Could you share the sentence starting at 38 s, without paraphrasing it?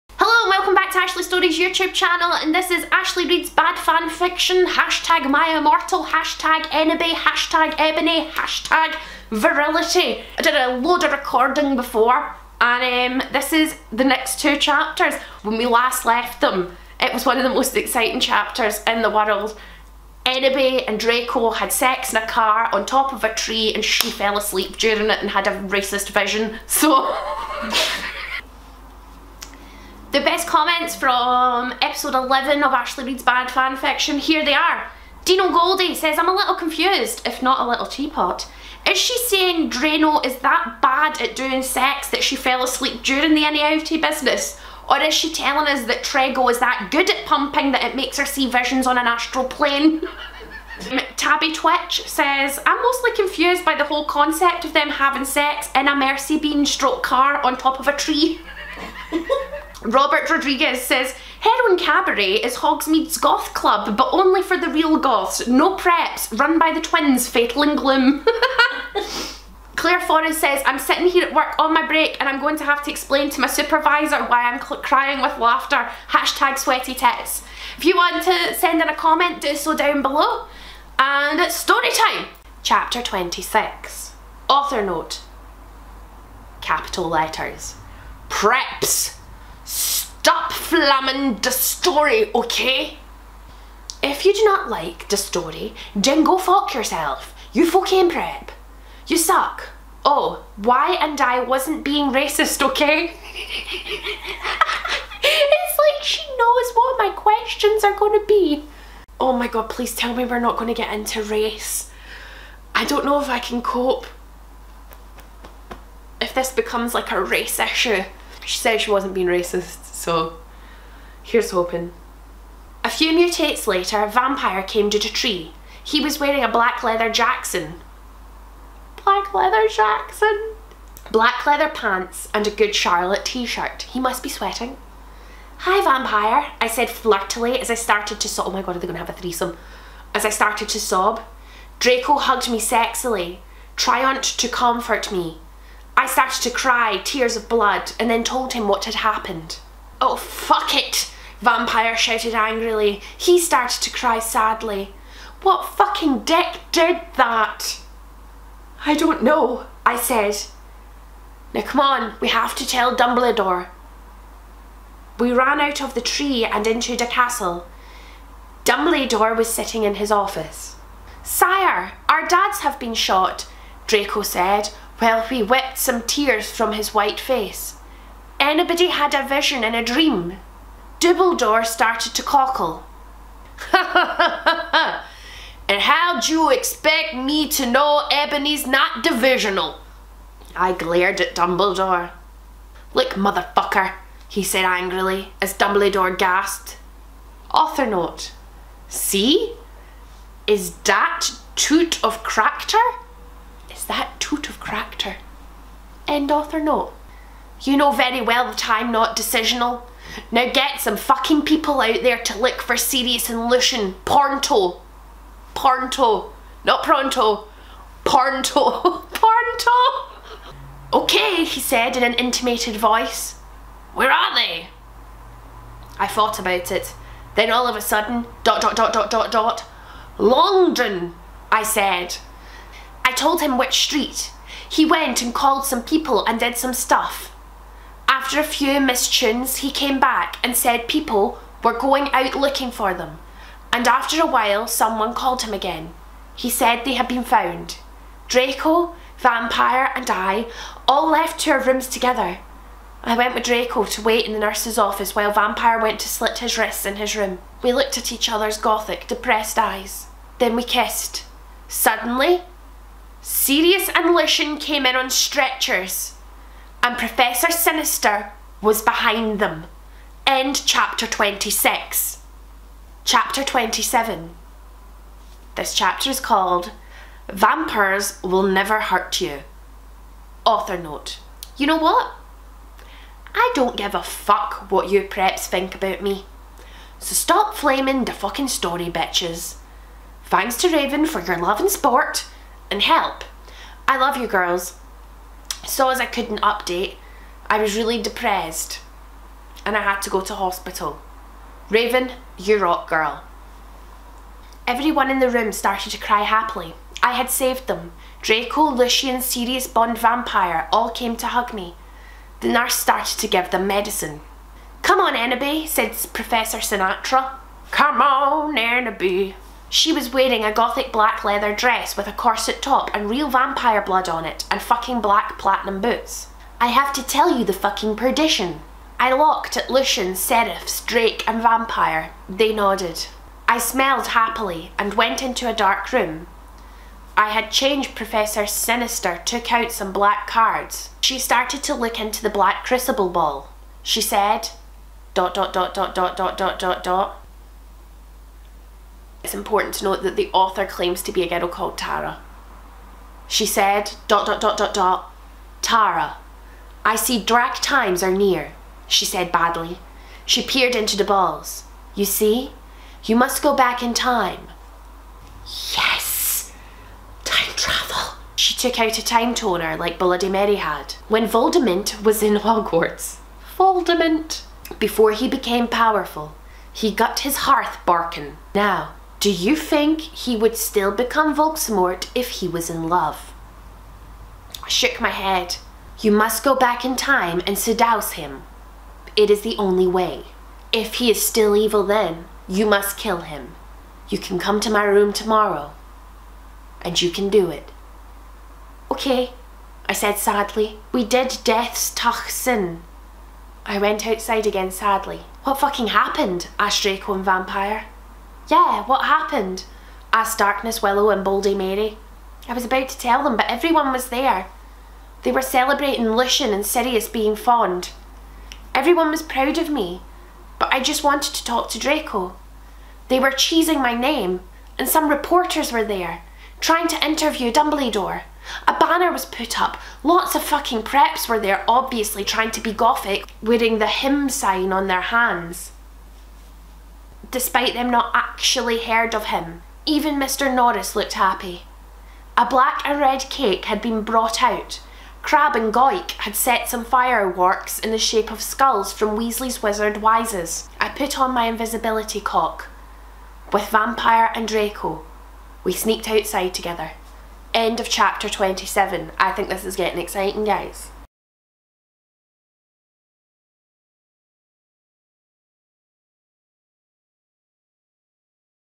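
Is she saying Drano is that bad at doing sex that she fell asleep during the NAFT business?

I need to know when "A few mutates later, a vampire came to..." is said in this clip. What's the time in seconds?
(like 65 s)
122 s.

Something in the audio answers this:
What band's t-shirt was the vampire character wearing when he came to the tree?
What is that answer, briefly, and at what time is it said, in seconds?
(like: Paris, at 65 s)
Good Charlotte, at 132 s.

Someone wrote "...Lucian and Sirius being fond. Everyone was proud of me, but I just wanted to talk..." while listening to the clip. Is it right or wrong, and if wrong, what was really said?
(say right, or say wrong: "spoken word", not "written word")
right.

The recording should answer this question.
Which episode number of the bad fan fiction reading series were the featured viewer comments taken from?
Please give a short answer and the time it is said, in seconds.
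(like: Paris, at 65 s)
11, at 31 s.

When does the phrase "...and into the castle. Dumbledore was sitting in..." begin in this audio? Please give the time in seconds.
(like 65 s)
166 s.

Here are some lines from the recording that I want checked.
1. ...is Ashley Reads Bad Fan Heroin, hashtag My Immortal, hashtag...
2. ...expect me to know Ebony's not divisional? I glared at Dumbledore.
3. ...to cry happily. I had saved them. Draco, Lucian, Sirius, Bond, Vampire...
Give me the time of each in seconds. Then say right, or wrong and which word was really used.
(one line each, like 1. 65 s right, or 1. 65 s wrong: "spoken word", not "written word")
1. 2 s wrong: "Fiction", not "Heroin"
2. 186 s right
3. 305 s right.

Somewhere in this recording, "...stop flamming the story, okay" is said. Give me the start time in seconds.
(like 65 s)
90 s.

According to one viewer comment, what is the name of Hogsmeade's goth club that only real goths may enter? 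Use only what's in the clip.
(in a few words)
Heroin Cabaret.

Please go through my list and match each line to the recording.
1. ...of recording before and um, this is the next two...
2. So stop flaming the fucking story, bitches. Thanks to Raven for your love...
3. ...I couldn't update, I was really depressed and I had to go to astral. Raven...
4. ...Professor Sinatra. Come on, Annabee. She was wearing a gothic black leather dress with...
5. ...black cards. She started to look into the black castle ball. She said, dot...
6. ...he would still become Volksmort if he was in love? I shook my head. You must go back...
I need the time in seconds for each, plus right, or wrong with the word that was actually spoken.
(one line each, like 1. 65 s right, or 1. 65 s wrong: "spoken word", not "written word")
1. 11 s right
2. 286 s right
3. 295 s wrong: "hospital", not "astral"
4. 316 s right
5. 339 s wrong: "crucible", not "castle"
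6. 380 s right.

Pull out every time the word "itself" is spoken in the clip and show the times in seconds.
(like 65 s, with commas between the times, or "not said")
not said.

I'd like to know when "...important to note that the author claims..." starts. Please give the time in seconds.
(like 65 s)
349 s.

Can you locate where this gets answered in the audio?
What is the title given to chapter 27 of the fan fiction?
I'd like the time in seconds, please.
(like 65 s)
277 s.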